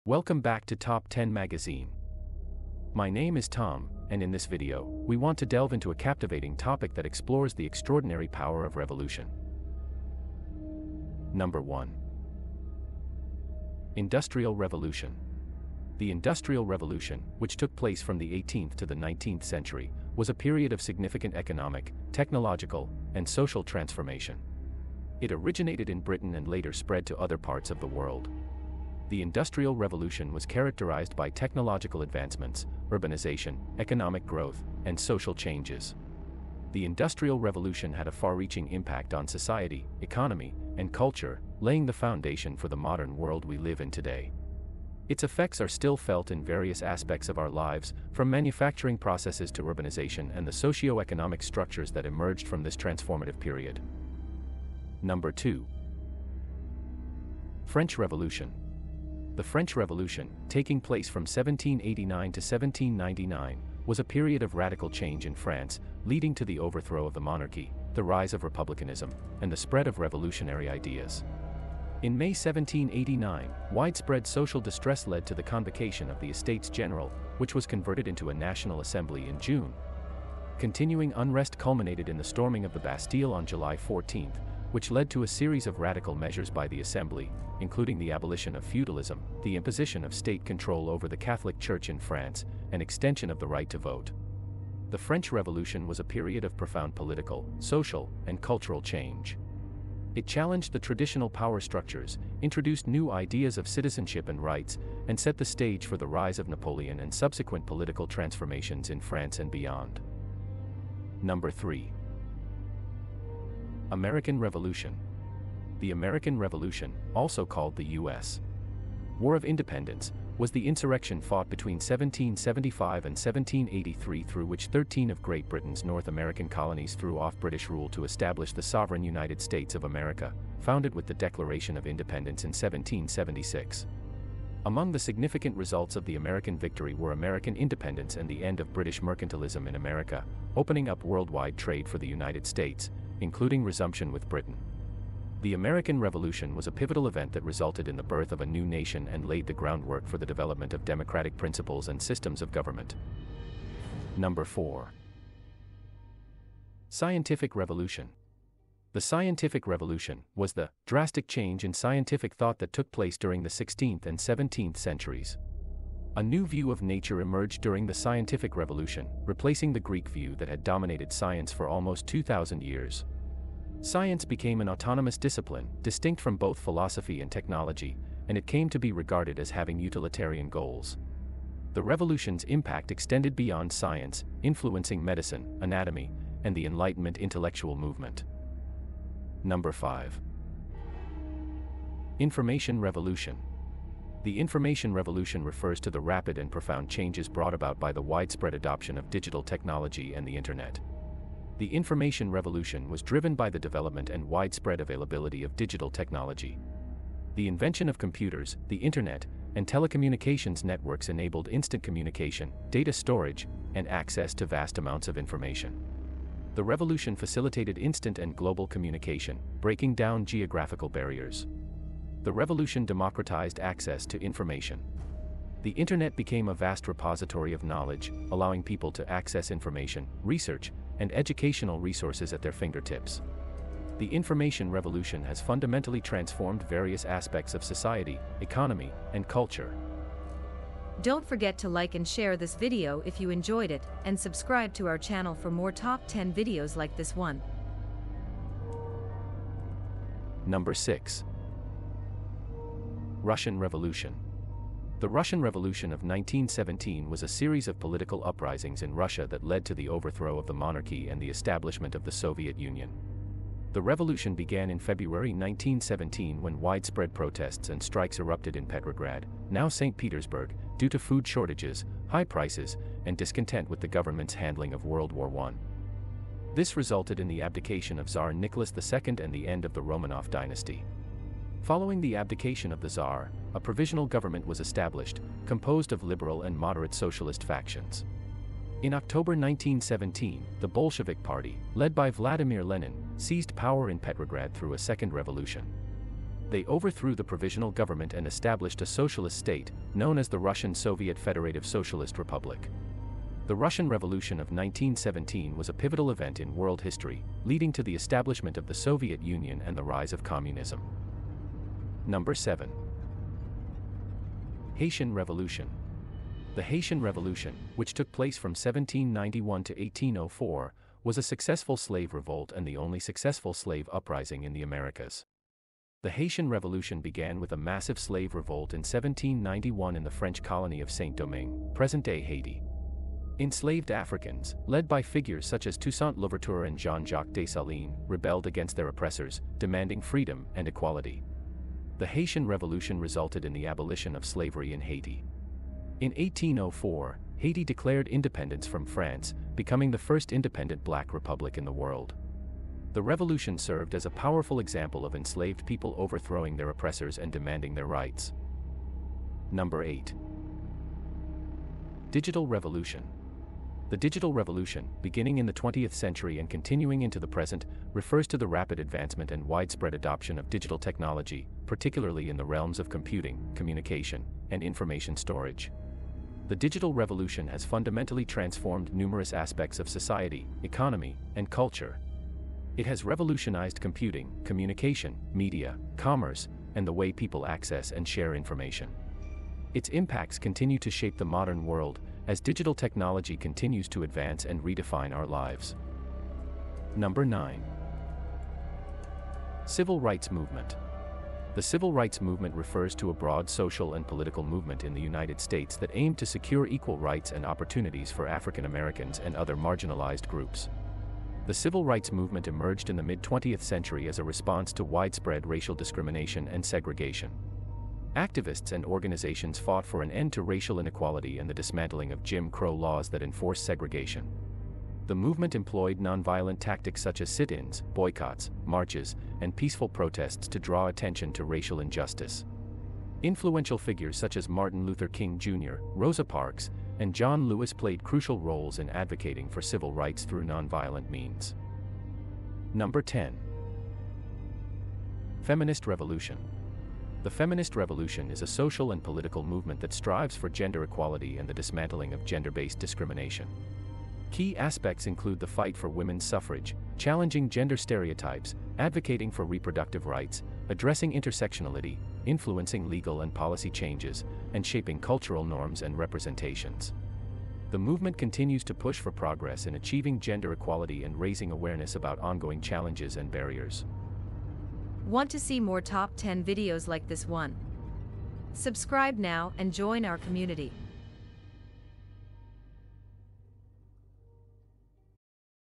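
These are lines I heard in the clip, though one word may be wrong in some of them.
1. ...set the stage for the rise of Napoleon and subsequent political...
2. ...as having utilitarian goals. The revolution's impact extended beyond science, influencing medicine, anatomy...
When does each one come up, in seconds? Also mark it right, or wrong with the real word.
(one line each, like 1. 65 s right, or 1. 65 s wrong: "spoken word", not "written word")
1. 105 s right
2. 179 s right.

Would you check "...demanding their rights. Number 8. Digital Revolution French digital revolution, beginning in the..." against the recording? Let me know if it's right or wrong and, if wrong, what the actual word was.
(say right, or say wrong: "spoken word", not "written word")
wrong: "The", not "French".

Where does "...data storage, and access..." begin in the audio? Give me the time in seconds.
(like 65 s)
212 s.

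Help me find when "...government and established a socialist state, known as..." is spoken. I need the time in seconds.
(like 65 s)
297 s.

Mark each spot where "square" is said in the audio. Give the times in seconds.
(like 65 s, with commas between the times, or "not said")
not said.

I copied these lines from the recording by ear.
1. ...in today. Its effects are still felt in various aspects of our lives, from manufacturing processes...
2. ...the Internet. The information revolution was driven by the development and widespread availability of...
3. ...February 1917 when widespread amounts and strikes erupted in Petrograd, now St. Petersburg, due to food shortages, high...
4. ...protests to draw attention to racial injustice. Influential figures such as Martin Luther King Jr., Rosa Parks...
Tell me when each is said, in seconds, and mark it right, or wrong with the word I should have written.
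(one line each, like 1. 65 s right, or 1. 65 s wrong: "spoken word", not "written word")
1. 43 s right
2. 200 s right
3. 264 s wrong: "protests", not "amounts"
4. 429 s right.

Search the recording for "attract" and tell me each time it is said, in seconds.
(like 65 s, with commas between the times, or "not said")
not said.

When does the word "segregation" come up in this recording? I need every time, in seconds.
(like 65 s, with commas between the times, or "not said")
416 s, 423 s.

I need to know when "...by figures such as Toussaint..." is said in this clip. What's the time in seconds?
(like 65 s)
334 s.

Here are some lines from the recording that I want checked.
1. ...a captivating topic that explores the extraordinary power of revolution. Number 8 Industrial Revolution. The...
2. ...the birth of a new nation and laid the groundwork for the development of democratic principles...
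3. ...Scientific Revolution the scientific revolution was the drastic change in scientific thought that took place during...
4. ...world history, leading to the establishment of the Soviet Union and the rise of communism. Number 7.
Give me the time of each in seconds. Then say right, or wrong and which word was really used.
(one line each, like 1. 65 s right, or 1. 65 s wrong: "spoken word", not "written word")
1. 5 s wrong: "1", not "8"
2. 147 s right
3. 156 s right
4. 306 s right.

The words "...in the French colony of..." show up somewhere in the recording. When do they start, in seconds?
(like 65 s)
329 s.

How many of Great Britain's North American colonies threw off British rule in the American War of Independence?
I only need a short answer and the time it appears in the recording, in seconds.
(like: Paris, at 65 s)
13, at 124 s.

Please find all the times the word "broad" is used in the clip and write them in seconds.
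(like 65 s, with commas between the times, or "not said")
403 s.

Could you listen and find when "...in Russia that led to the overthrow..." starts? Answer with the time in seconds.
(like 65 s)
258 s.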